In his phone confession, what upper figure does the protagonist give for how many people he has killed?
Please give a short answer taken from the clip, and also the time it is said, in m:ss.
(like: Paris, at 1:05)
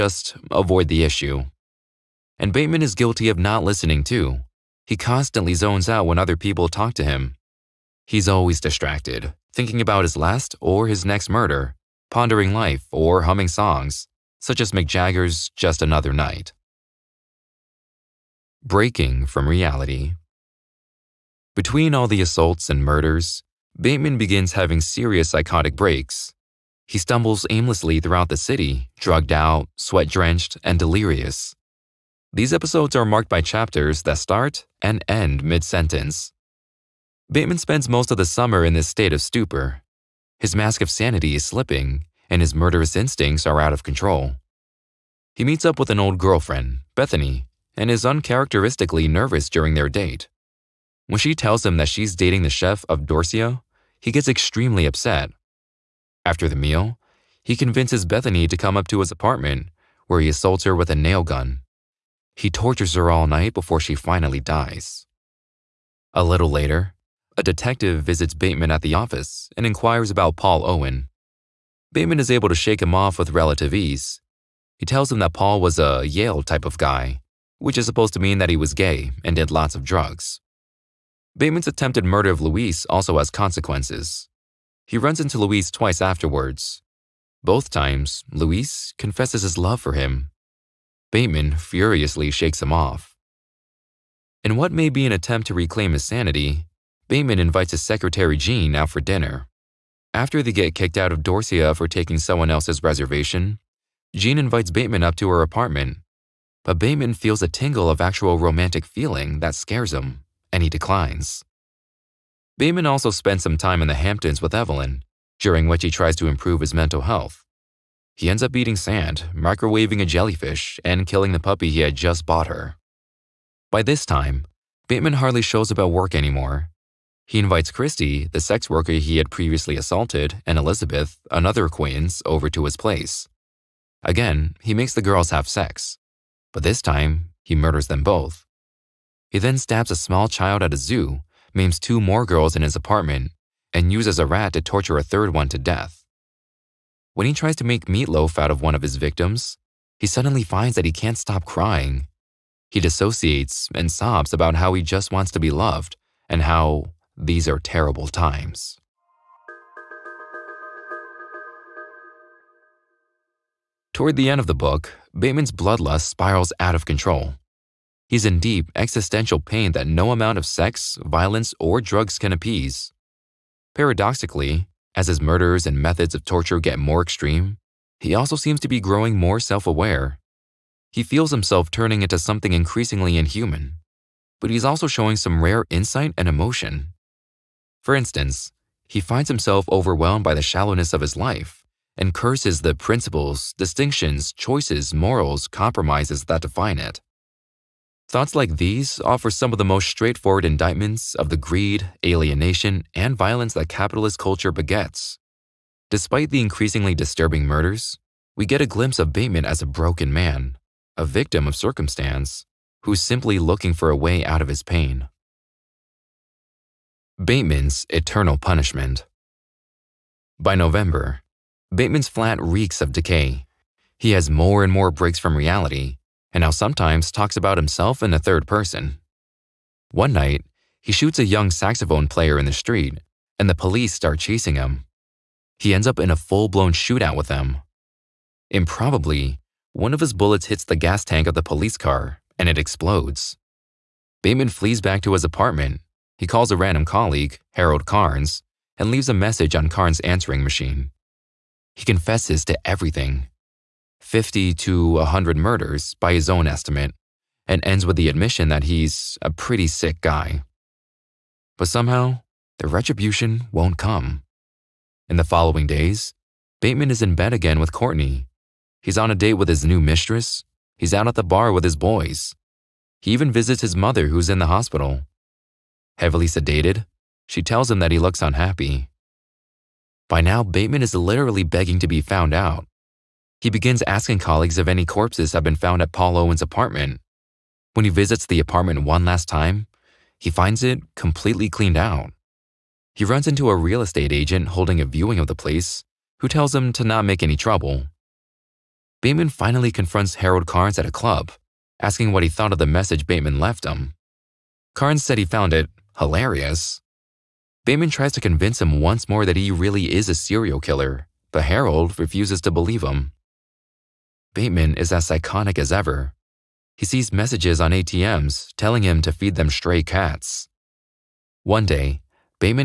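100, at 4:14.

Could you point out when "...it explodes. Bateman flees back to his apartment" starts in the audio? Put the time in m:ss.
4:02.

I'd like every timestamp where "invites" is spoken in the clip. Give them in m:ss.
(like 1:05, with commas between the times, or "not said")
1:37, 1:44, 2:07.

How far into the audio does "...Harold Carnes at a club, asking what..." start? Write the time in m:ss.
5:00.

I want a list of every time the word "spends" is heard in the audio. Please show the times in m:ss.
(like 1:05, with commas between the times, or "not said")
0:37, 1:53.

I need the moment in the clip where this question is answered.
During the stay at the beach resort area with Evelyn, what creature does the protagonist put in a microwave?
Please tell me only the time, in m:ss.
2:00.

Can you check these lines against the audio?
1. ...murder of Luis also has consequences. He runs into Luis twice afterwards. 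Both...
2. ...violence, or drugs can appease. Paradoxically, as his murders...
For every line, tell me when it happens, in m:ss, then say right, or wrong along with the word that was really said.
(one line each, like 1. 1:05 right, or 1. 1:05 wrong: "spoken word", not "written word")
1. 1:22 right
2. 2:51 right.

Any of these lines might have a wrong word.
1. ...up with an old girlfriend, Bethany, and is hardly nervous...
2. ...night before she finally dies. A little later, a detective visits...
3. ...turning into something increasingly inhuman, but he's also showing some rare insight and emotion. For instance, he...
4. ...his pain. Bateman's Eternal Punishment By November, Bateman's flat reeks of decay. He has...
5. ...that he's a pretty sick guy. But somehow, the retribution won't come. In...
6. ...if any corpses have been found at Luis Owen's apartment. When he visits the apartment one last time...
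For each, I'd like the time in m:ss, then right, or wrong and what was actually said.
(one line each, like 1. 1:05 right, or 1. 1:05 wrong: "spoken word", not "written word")
1. 0:45 wrong: "uncharacteristically", not "hardly"
2. 1:03 right
3. 3:01 right
4. 3:34 right
5. 4:18 right
6. 4:44 wrong: "Paul", not "Luis".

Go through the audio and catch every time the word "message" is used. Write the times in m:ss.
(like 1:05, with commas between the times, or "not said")
4:09, 5:02, 5:17.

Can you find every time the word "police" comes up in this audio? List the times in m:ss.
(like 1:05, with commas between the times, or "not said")
3:53, 4:01.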